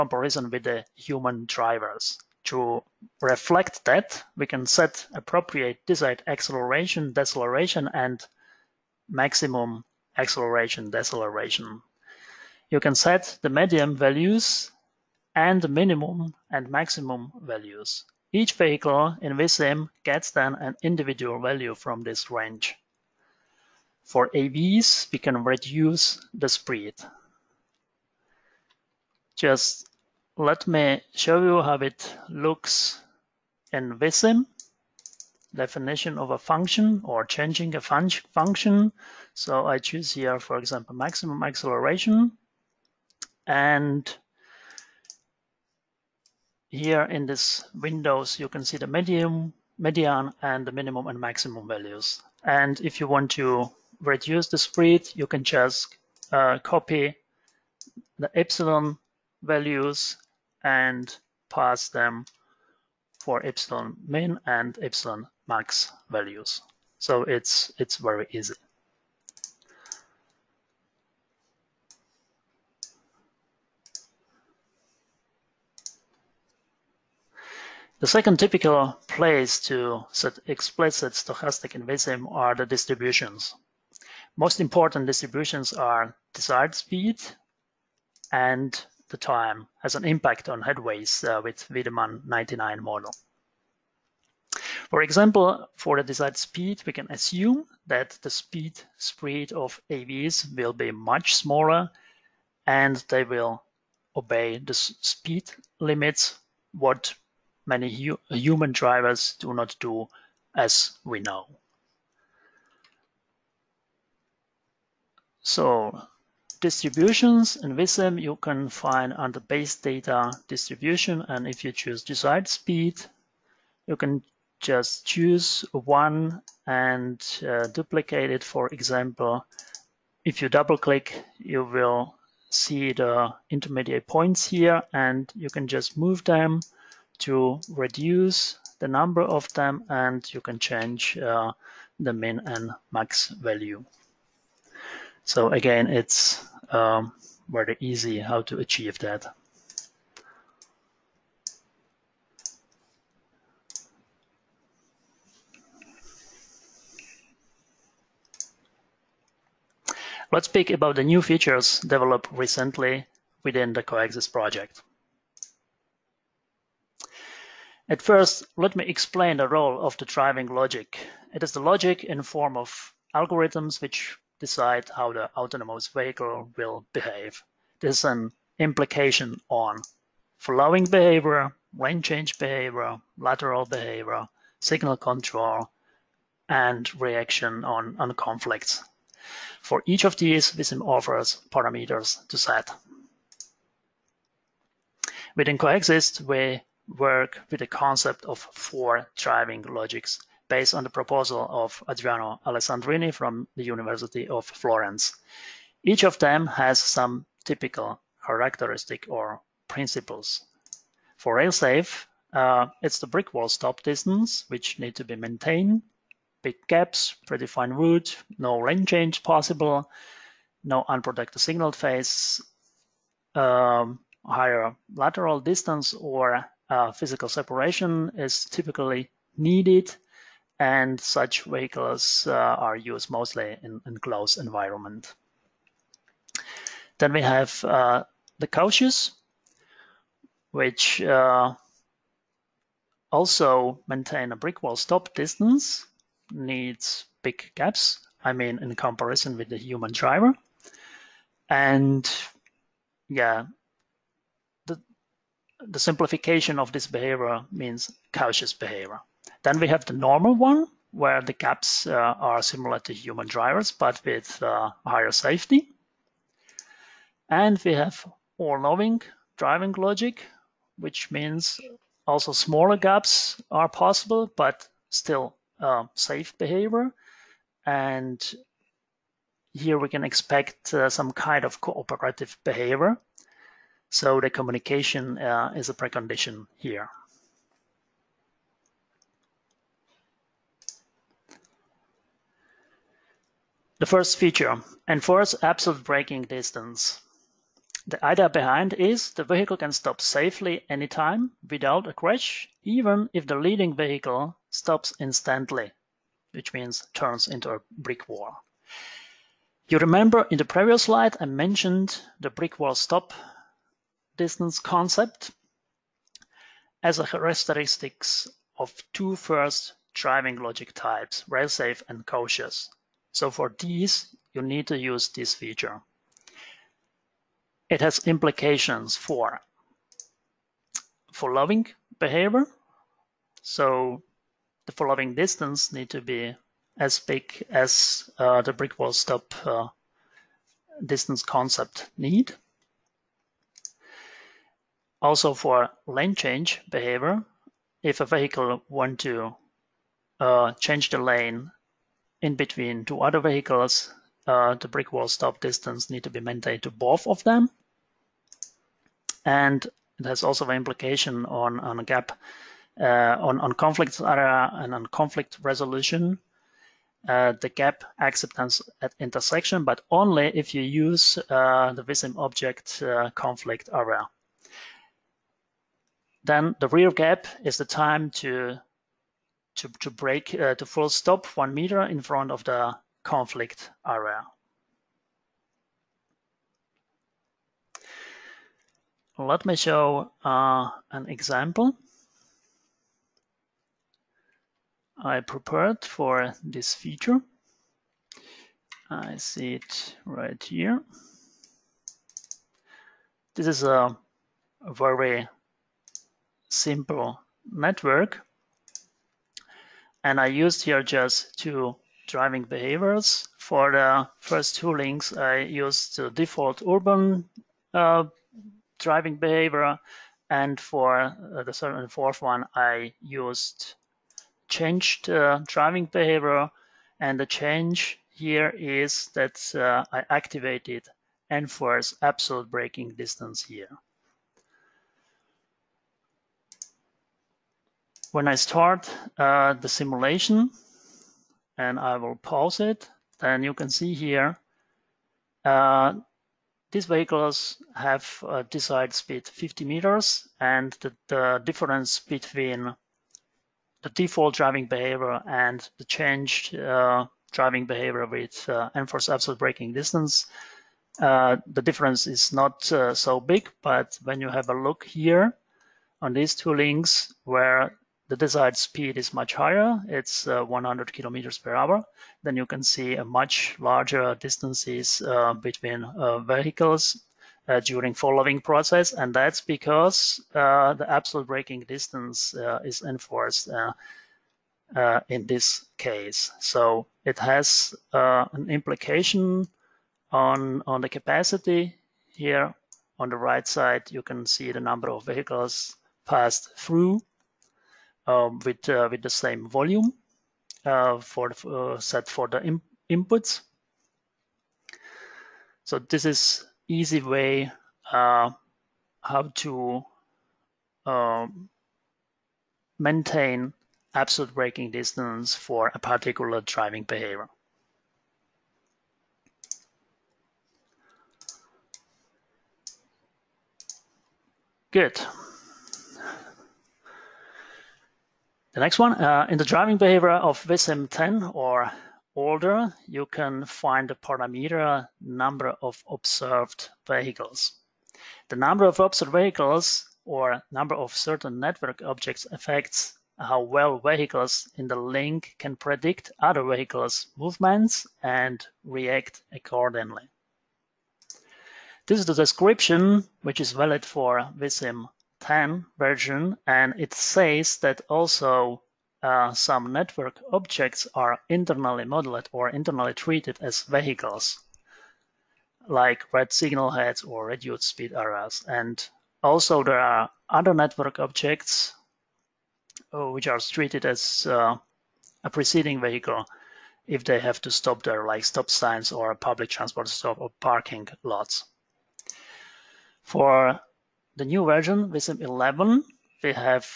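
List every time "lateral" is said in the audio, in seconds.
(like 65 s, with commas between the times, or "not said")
183 s, 224 s.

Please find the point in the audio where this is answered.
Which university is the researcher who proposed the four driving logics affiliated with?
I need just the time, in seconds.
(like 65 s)
203 s.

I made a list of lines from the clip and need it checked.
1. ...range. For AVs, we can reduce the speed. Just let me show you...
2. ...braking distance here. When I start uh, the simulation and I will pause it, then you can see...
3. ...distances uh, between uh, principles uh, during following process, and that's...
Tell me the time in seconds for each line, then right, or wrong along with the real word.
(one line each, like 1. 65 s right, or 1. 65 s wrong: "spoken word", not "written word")
1. 22 s right
2. 432 s right
3. 474 s wrong: "vehicles", not "principles".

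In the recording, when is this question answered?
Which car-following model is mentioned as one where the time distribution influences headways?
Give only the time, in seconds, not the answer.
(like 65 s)
91 s.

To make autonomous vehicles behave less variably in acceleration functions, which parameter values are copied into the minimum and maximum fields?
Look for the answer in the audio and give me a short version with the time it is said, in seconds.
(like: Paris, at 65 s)
epsilon values, at 58 s.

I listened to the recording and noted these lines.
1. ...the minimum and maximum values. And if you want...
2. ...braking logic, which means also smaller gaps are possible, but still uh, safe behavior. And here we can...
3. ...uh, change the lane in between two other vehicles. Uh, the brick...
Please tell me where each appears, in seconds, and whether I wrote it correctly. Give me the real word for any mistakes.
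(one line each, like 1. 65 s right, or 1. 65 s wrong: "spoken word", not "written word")
1. 50 s right
2. 269 s wrong: "driving", not "braking"
3. 350 s right.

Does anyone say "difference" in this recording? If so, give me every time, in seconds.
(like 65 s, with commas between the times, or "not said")
451 s, 461 s.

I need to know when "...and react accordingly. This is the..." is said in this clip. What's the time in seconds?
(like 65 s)
548 s.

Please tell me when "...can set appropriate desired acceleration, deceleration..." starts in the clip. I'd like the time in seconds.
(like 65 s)
4 s.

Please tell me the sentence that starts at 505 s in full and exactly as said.
So this is easy way how to um, maintain absolute braking distance for a particular driving behavior.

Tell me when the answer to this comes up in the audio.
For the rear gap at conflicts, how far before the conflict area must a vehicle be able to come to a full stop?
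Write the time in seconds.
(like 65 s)
381 s.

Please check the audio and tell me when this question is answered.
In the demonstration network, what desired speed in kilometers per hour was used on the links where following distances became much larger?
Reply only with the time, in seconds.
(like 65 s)
470 s.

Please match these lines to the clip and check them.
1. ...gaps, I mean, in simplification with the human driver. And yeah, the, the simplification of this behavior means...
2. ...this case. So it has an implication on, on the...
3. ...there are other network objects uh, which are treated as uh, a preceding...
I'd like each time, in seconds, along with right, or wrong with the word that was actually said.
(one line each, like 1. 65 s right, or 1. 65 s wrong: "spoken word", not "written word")
1. 247 s wrong: "comparison", not "simplification"
2. 485 s right
3. 569 s right.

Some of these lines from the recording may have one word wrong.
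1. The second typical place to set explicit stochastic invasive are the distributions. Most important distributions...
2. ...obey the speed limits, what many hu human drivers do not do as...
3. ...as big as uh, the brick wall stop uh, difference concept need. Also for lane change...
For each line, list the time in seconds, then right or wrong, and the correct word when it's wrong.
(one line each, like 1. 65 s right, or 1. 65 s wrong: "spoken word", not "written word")
1. 77 s right
2. 104 s right
3. 336 s wrong: "distance", not "difference".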